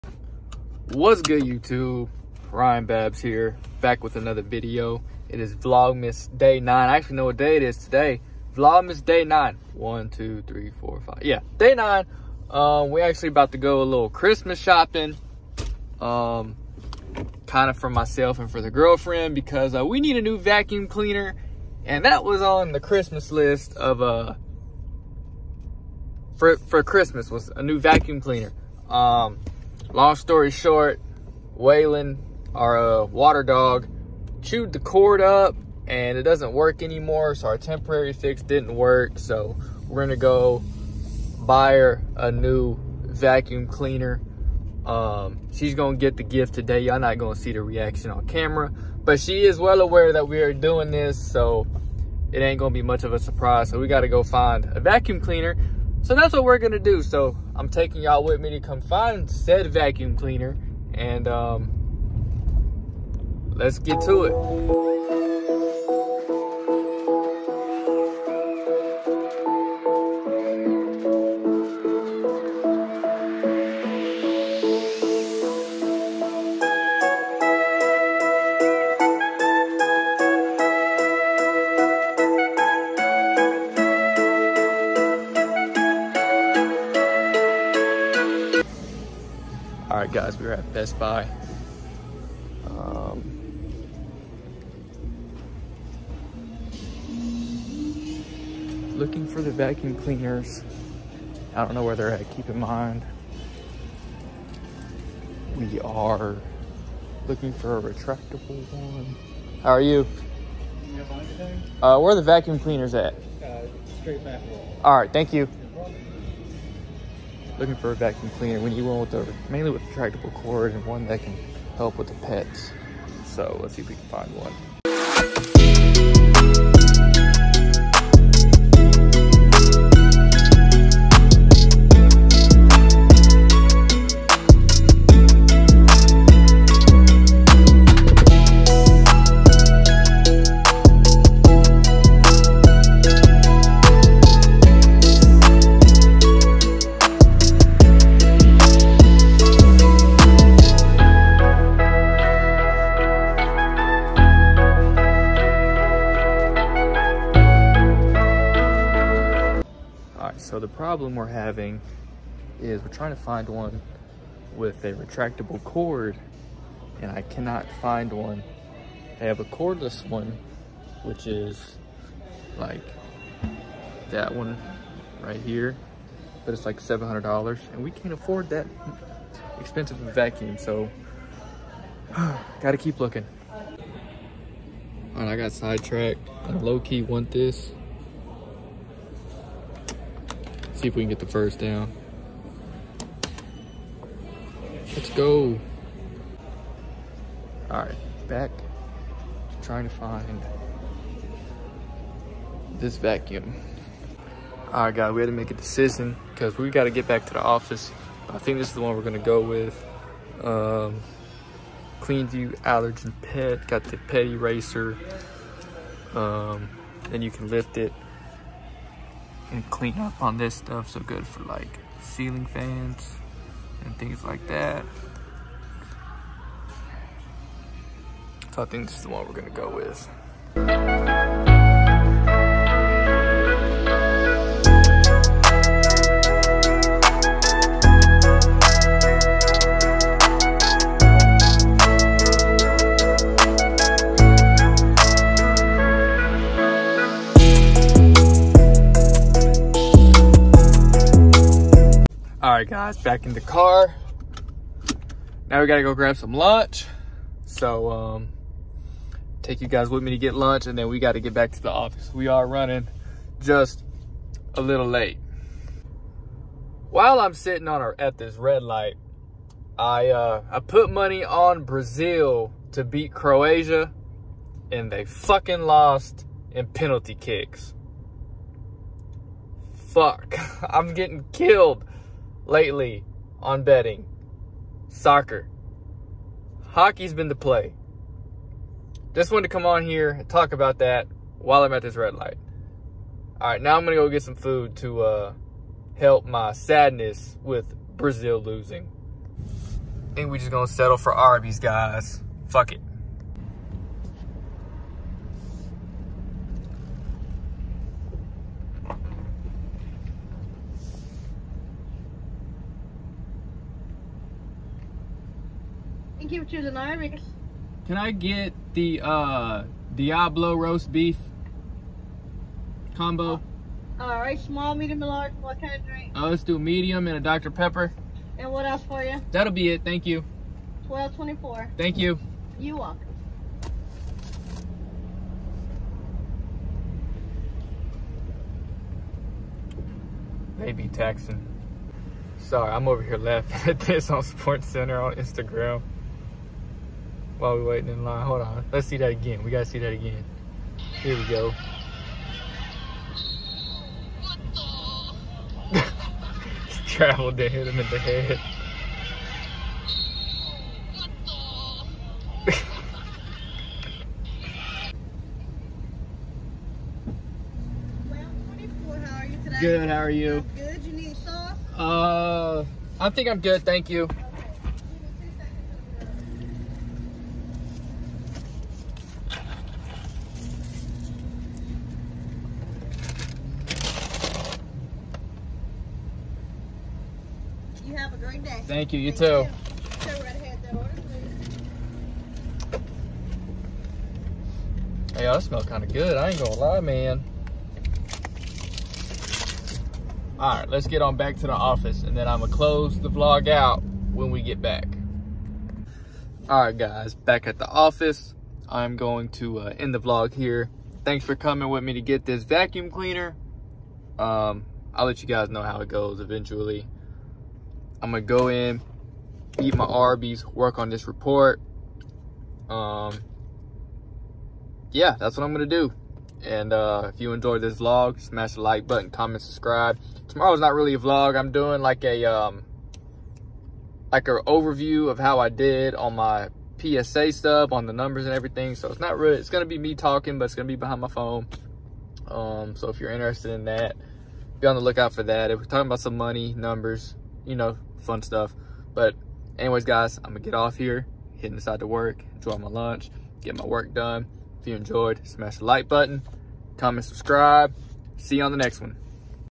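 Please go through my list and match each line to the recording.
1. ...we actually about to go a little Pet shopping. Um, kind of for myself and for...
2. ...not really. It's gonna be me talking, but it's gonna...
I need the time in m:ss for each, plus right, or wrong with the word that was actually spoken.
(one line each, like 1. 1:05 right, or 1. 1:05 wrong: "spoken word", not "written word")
1. 0:12 wrong: "Christmas", not "Pet"
2. 7:18 right.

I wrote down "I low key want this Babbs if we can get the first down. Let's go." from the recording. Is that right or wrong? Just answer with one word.
wrong.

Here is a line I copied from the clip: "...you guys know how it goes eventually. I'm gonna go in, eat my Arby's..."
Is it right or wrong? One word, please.
right.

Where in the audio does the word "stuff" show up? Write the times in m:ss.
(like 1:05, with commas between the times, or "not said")
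3:40, 7:17, 7:28.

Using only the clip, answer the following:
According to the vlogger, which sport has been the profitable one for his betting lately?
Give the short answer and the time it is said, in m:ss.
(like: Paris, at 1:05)
Hockey, at 4:46.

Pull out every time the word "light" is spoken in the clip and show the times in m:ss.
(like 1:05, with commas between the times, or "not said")
4:28, 4:52.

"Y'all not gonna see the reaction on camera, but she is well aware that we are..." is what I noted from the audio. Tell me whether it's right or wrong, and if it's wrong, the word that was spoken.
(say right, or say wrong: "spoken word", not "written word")
right.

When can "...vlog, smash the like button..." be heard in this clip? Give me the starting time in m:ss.
7:07.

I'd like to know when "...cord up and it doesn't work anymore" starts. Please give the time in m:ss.
0:34.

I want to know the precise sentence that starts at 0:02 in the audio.
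Ryan Babbs here, back with another video.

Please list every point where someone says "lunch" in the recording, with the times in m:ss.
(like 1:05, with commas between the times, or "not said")
4:16, 4:20, 7:32.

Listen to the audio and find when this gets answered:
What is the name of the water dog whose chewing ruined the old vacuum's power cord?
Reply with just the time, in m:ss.
0:31.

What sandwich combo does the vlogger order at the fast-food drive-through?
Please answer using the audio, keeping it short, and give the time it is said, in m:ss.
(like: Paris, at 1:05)
Diablo roast beef combo, at 5:19.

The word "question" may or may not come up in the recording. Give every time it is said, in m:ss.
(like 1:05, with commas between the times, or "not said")
not said.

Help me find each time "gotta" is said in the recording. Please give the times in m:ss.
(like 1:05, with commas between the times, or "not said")
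0:53, 3:02, 4:15, 4:20.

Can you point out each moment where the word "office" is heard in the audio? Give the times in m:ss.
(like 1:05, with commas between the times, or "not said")
3:27, 4:21, 6:41, 6:47.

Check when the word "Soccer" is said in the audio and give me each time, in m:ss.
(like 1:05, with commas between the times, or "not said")
4:44.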